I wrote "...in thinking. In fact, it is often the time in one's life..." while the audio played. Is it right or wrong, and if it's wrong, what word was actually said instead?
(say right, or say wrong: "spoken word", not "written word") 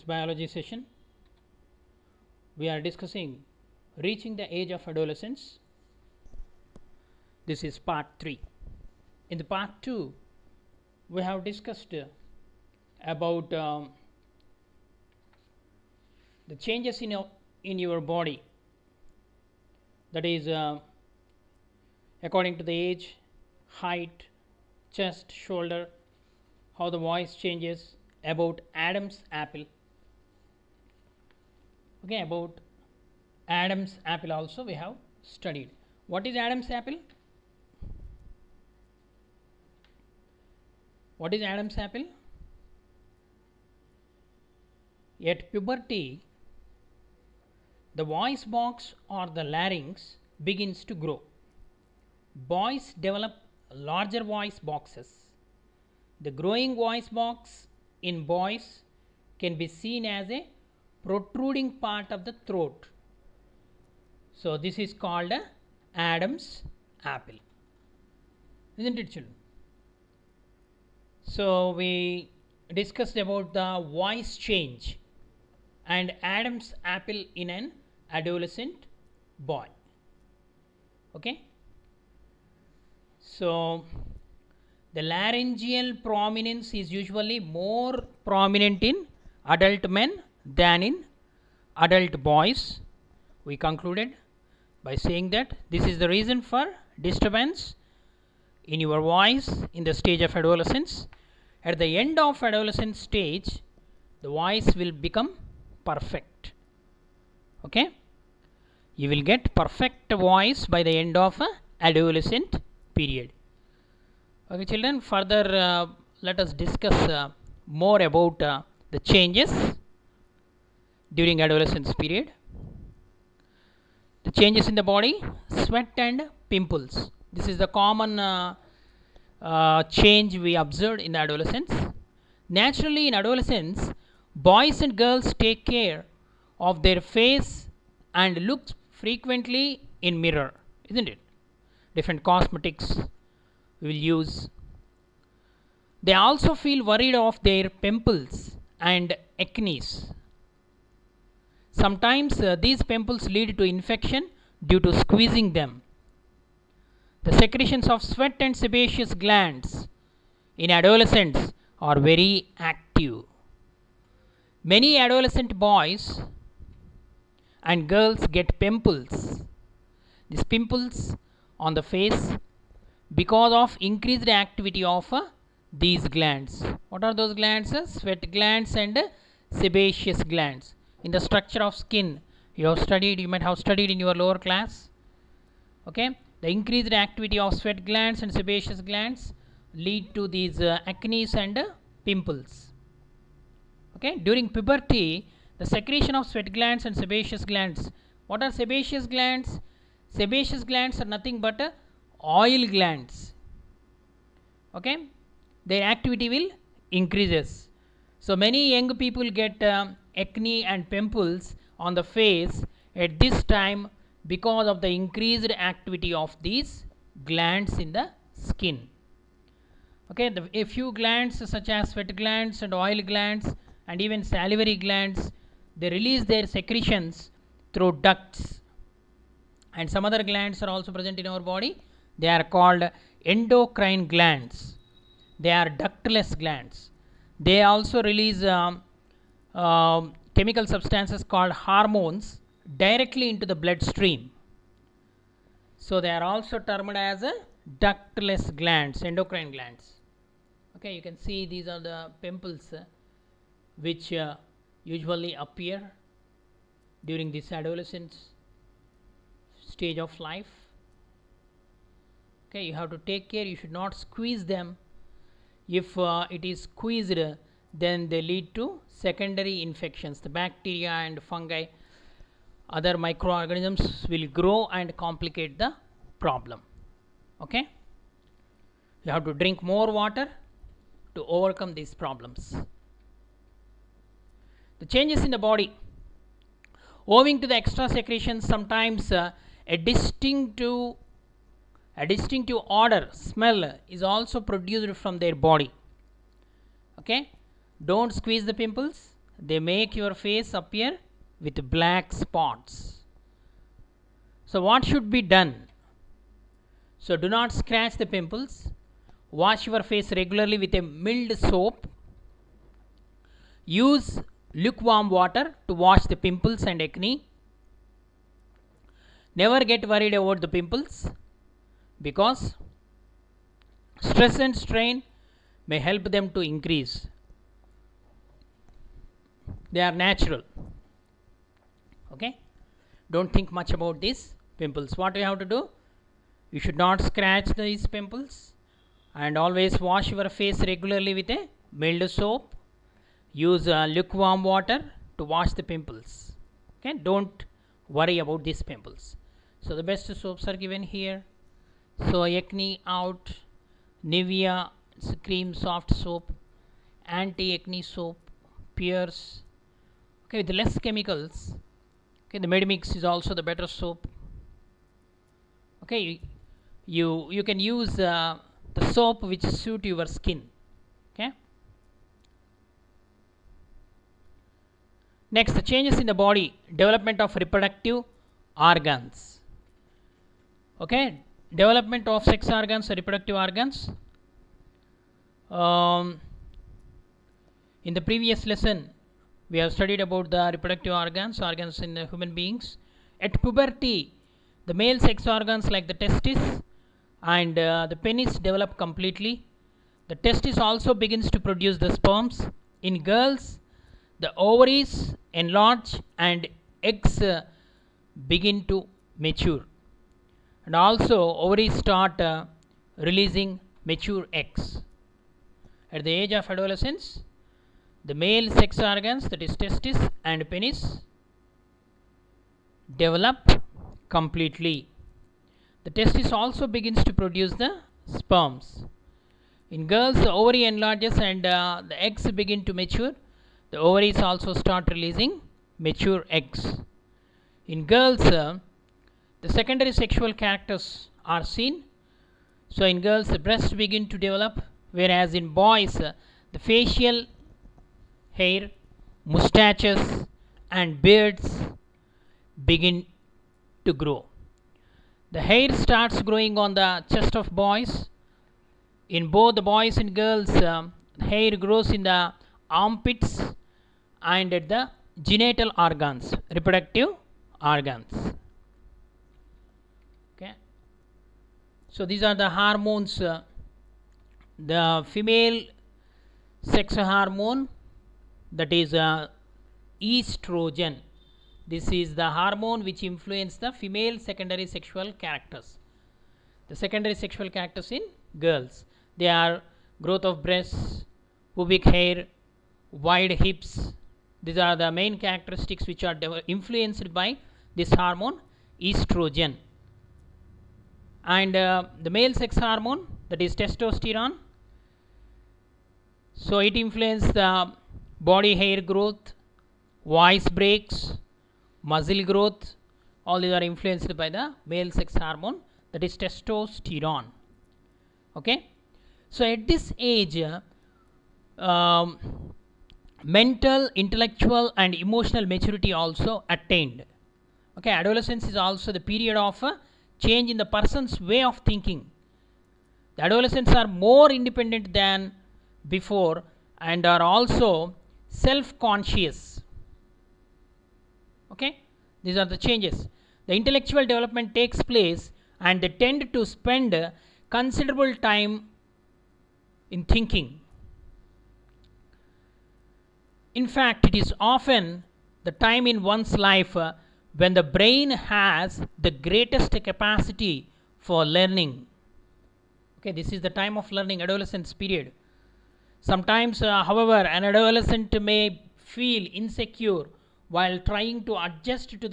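right.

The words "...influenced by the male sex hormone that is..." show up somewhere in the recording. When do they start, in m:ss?
8:33.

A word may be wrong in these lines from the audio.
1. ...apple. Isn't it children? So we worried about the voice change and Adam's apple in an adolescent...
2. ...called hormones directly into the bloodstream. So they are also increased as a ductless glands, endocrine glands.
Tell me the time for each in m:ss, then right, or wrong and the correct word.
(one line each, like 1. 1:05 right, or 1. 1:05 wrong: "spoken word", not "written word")
1. 1:07 wrong: "discussed", not "worried"
2. 4:01 wrong: "termed", not "increased".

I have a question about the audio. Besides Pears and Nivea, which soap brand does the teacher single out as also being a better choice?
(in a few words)
Medimix.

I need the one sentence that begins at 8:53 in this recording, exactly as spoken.
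The adolescents are more independent than before and are also self conscious.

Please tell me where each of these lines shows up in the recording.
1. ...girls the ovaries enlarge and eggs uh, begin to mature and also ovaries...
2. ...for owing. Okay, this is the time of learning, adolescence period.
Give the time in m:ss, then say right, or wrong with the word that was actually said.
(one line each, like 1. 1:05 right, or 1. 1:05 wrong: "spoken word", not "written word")
1. 6:43 right
2. 9:20 wrong: "learning", not "owing".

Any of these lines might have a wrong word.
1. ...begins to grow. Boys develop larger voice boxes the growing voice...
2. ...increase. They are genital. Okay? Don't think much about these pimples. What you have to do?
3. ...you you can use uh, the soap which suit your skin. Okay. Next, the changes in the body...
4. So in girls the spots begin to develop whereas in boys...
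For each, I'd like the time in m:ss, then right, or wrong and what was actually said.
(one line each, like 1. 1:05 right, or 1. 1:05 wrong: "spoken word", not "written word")
1. 0:50 right
2. 5:26 wrong: "natural", not "genital"
3. 6:06 right
4. 7:22 wrong: "breasts", not "spots".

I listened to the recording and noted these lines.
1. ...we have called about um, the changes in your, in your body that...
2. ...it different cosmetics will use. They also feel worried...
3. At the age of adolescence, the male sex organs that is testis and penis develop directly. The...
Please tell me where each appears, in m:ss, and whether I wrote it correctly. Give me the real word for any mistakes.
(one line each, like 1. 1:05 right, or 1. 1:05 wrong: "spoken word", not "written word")
1. 0:11 wrong: "discussed", not "called"
2. 2:21 right
3. 6:55 wrong: "completely", not "directly".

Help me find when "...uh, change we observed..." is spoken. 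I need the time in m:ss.
2:09.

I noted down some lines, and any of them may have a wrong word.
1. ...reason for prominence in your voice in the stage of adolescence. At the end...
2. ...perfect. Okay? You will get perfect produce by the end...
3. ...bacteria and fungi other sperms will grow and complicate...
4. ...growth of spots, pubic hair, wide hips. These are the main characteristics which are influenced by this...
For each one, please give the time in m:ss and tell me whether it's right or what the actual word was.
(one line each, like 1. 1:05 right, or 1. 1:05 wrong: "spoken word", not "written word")
1. 1:36 wrong: "disturbance", not "prominence"
2. 1:45 wrong: "voice", not "produce"
3. 4:30 wrong: "microorganisms", not "sperms"
4. 8:09 wrong: "breasts", not "spots".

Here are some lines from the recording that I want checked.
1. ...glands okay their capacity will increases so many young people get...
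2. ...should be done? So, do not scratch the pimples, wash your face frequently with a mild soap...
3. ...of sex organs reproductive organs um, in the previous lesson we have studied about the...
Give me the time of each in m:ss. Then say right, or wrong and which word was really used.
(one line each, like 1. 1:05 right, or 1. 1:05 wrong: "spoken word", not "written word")
1. 3:22 wrong: "activity", not "capacity"
2. 5:04 wrong: "regularly", not "frequently"
3. 6:22 right.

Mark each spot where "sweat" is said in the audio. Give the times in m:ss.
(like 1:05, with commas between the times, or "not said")
2:05, 2:38, 2:57, 3:07, 3:16, 3:41.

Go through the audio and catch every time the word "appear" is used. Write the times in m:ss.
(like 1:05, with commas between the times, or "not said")
4:15, 5:00.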